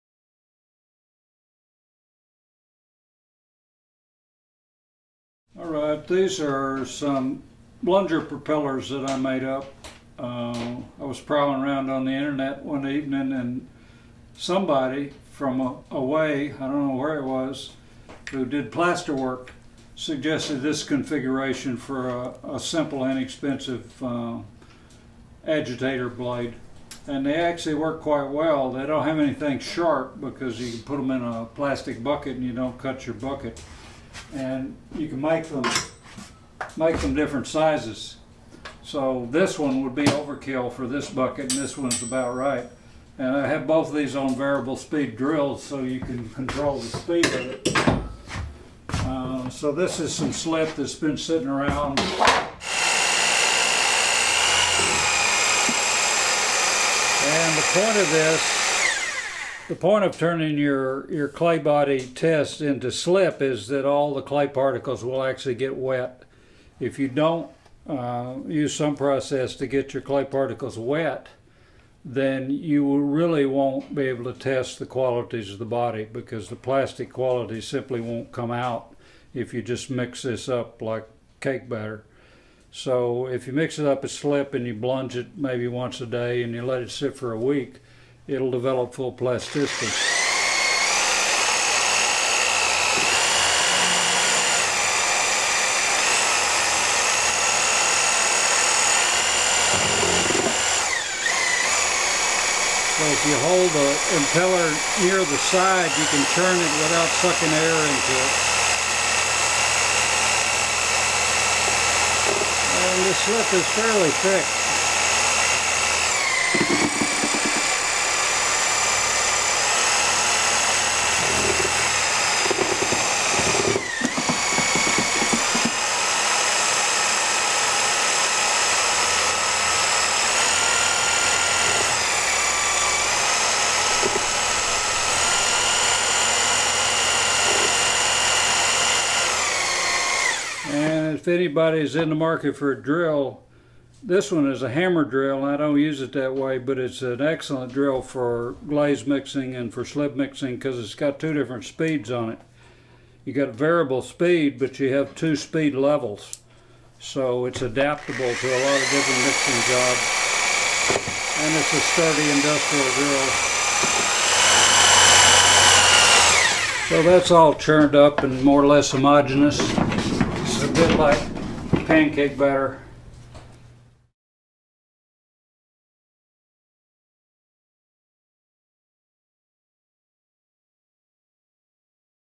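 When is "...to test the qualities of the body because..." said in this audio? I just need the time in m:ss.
1:14.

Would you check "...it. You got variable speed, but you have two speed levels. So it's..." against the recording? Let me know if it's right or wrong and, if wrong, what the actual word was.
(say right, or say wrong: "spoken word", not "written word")
right.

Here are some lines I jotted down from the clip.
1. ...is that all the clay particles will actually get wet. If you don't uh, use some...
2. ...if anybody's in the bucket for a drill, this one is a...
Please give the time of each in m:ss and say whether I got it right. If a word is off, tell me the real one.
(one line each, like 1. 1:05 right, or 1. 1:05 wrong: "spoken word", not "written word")
1. 1:03 right
2. 2:21 wrong: "market", not "bucket".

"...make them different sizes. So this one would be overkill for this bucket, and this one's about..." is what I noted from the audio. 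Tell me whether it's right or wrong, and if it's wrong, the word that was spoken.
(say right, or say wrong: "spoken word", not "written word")
right.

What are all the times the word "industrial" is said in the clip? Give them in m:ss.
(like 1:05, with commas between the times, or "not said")
2:42.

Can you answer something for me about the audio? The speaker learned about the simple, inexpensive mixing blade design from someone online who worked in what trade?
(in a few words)
plaster work.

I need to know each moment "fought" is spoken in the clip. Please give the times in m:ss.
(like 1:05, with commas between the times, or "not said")
not said.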